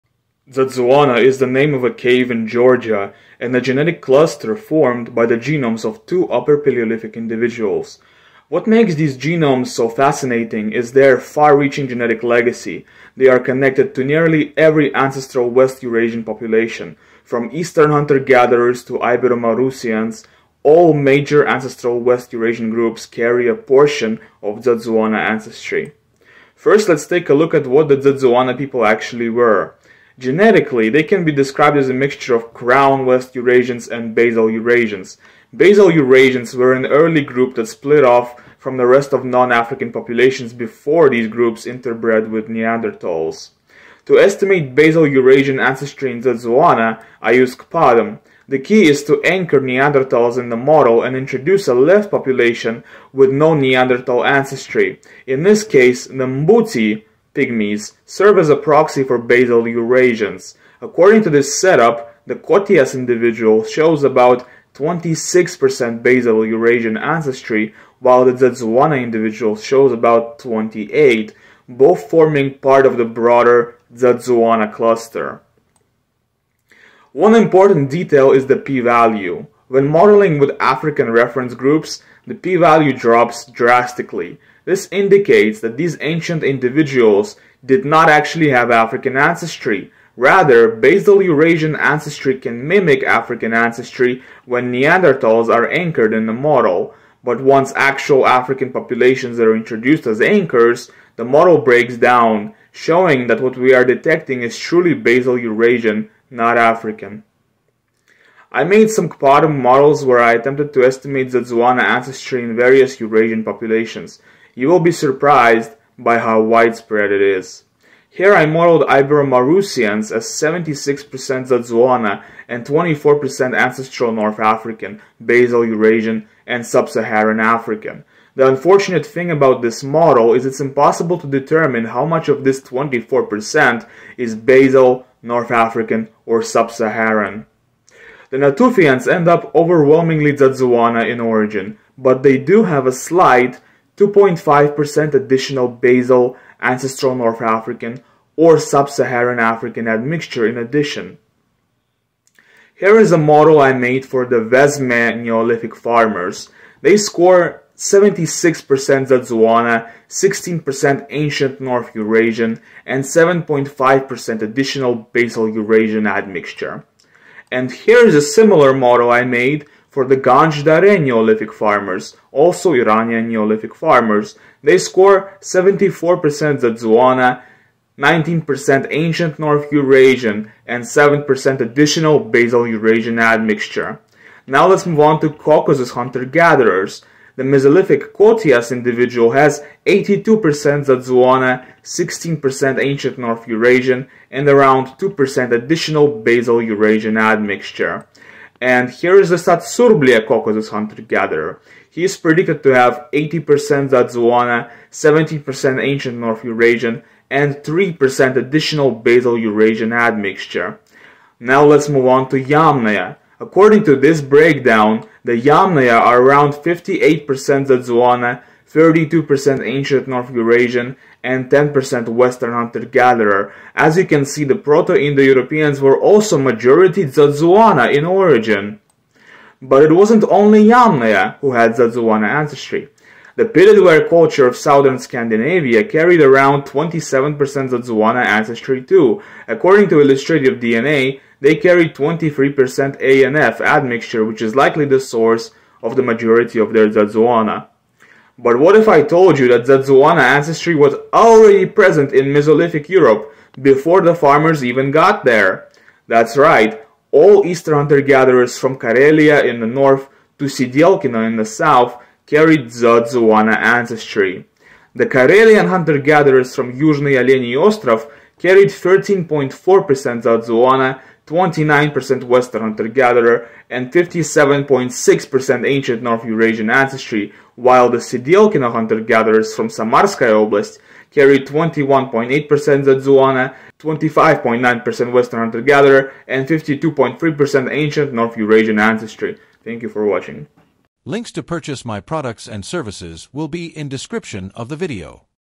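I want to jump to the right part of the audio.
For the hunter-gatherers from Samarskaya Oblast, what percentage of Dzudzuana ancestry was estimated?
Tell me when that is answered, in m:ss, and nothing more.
4:41.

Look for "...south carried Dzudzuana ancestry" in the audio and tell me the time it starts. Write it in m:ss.
4:21.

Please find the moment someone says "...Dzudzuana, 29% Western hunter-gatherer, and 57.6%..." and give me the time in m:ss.
4:30.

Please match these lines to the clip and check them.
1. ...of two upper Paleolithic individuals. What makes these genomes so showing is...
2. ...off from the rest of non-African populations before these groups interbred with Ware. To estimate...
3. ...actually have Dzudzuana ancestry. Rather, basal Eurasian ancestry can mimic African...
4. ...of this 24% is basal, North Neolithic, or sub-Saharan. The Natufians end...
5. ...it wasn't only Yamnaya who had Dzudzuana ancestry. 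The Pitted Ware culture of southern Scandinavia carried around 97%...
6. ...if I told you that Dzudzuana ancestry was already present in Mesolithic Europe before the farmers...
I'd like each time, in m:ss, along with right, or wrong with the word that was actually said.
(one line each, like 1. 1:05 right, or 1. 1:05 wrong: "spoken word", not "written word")
1. 0:05 wrong: "fascinating", not "showing"
2. 0:38 wrong: "Neanderthals", not "Ware"
3. 1:28 wrong: "African", not "Dzudzuana"
4. 2:12 wrong: "African", not "Neolithic"
5. 3:49 wrong: "27", not "97"
6. 4:08 right.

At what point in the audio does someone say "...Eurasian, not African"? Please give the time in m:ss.
1:45.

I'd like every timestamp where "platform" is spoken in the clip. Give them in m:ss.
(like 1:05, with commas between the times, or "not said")
not said.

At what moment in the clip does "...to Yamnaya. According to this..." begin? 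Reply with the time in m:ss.
3:32.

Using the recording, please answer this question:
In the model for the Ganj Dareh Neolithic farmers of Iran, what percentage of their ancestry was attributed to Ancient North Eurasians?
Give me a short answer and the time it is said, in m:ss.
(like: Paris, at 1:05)
19%, at 2:57.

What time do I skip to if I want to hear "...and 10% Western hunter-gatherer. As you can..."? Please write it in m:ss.
3:41.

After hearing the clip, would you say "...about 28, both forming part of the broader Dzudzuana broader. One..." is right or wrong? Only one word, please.
wrong.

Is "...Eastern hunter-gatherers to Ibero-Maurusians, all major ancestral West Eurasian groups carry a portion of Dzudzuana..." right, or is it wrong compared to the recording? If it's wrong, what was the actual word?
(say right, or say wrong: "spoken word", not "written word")
right.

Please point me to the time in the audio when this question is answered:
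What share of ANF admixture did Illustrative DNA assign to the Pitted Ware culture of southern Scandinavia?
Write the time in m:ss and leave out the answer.
4:01.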